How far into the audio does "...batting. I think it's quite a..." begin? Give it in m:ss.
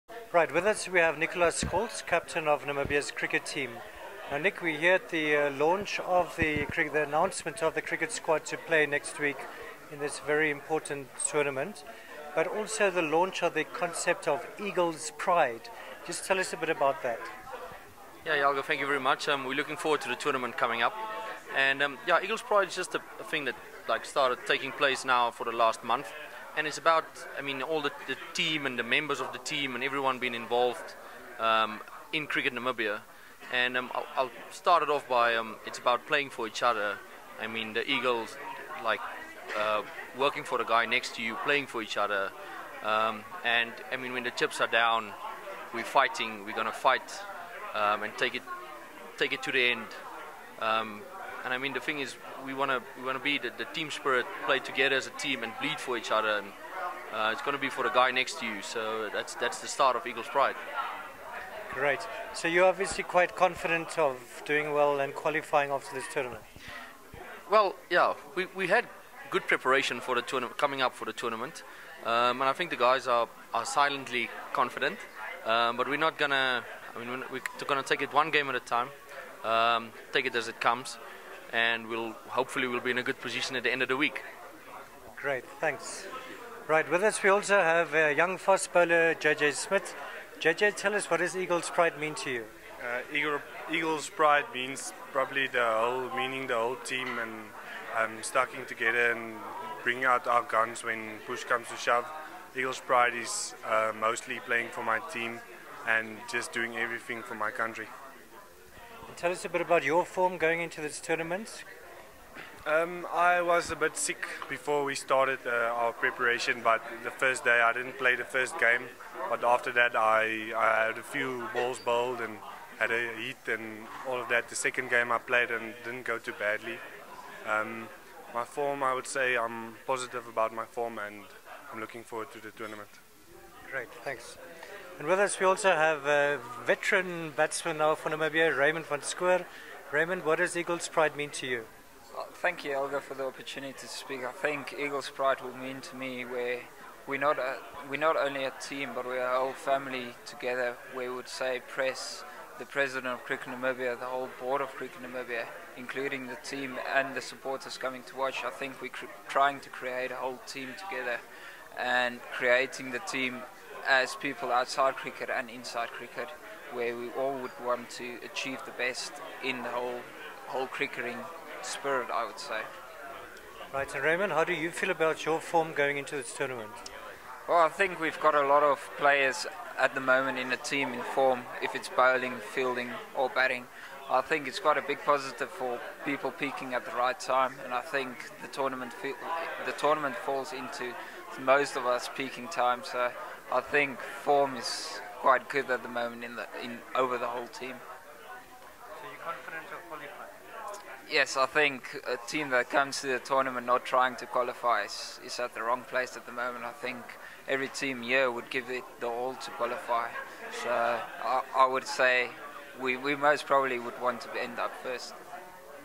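3:03.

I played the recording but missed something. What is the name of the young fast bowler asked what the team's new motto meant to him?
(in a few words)
JJ Smit.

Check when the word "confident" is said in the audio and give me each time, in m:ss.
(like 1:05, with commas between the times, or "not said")
1:03, 1:14, 3:19.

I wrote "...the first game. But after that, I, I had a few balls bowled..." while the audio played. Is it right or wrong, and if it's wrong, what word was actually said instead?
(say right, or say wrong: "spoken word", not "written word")
right.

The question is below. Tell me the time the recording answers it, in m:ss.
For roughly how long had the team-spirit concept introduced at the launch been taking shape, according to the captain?
0:25.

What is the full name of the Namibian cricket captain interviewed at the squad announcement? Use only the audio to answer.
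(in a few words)
Nicolaas Scholtz.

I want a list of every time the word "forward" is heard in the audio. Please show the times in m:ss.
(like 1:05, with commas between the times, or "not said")
0:19, 2:12.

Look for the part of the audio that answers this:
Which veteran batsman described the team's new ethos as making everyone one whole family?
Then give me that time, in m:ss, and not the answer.
2:18.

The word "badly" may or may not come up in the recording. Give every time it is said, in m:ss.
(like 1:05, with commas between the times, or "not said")
2:06.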